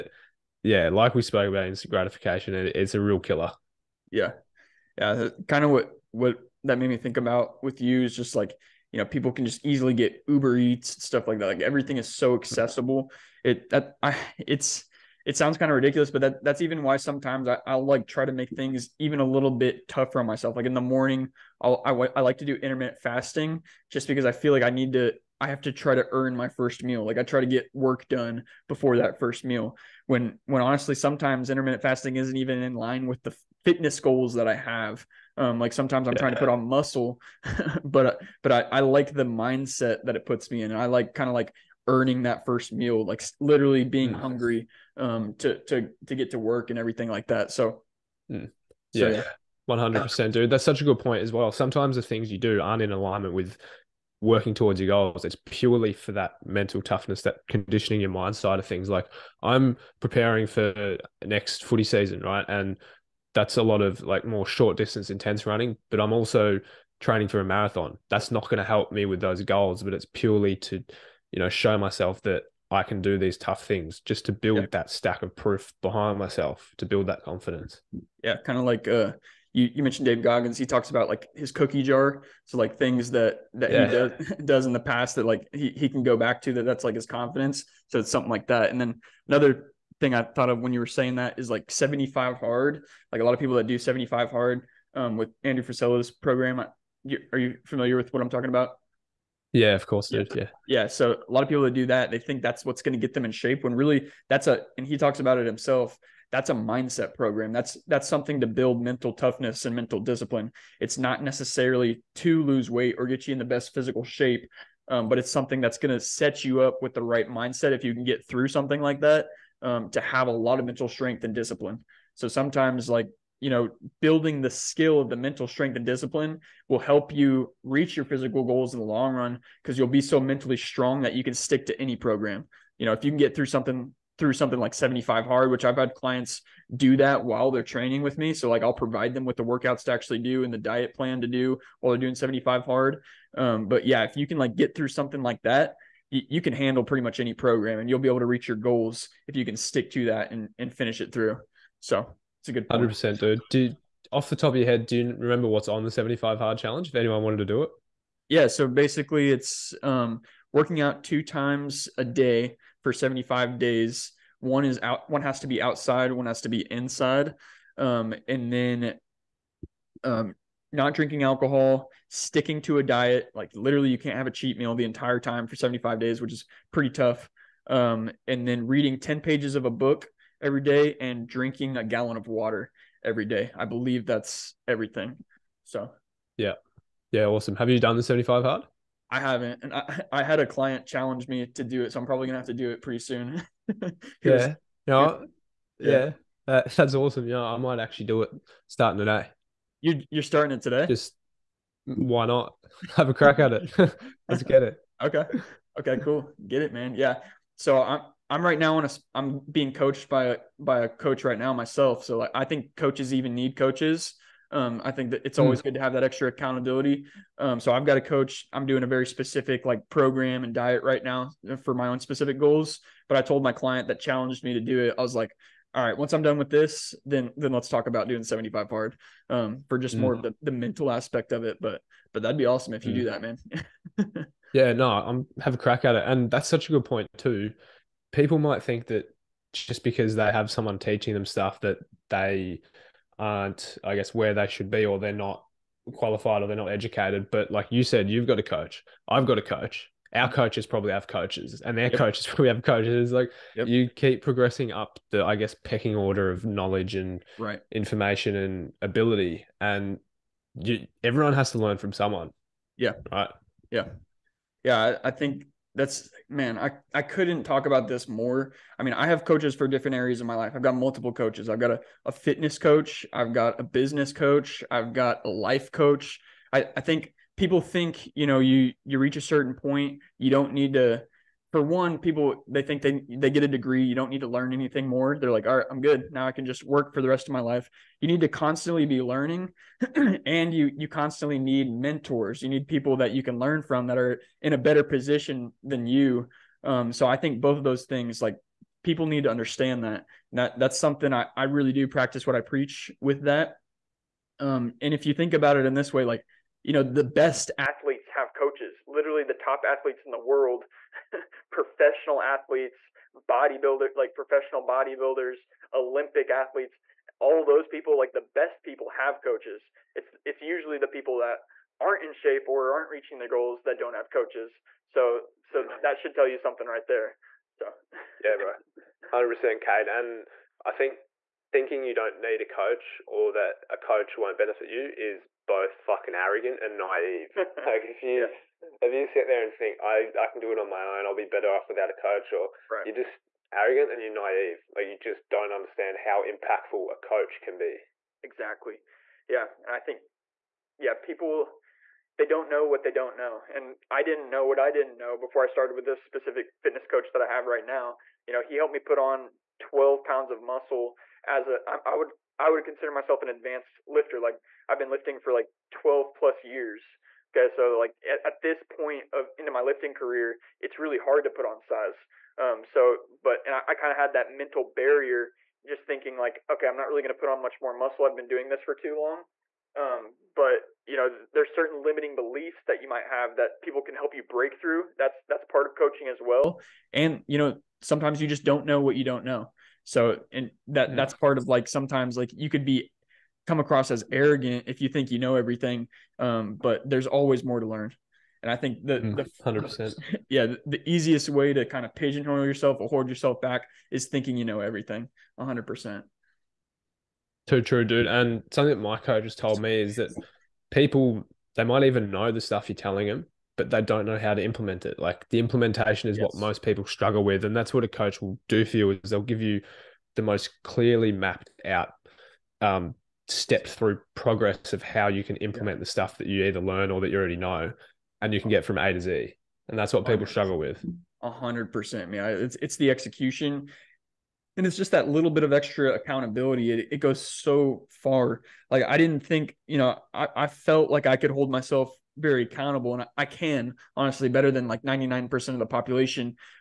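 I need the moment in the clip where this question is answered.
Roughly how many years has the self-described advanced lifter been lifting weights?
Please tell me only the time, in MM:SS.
06:05.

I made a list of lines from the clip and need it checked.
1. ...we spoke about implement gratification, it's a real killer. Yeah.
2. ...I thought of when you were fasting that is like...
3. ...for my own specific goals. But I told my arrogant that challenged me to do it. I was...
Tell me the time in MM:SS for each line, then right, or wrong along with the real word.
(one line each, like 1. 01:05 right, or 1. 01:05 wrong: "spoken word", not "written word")
1. 00:01 wrong: "instant", not "implement"
2. 01:30 wrong: "saying", not "fasting"
3. 03:41 wrong: "client", not "arrogant".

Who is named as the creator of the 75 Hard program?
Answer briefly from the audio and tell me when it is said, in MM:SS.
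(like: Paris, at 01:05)
Andrew Frisella, at 01:35.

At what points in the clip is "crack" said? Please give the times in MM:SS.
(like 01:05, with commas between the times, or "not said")
03:23, 03:55.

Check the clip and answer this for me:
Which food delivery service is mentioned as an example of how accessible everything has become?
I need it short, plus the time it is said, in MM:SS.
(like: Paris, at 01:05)
Uber Eats, at 00:10.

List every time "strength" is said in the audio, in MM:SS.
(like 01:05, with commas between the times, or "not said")
02:00, 02:05.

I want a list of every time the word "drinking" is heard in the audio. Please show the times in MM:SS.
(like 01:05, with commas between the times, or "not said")
02:50, 03:01.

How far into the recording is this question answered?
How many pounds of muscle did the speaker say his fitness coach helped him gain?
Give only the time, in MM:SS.
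05:59.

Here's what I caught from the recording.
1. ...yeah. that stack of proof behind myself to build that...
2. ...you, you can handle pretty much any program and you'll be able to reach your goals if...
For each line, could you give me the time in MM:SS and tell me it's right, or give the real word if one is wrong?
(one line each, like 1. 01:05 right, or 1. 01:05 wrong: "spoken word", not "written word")
1. 01:14 right
2. 02:26 right.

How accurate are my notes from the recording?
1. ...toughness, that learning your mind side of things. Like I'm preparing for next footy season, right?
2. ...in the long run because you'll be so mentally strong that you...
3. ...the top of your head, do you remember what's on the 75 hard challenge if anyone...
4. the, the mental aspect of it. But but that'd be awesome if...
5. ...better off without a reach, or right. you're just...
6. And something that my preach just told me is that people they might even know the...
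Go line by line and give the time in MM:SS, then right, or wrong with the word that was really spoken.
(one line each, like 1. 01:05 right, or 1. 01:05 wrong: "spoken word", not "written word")
1. 00:56 wrong: "conditioning", not "learning"
2. 02:08 right
3. 02:34 right
4. 03:50 right
5. 05:41 wrong: "coach", not "reach"
6. 06:48 wrong: "coach", not "preach".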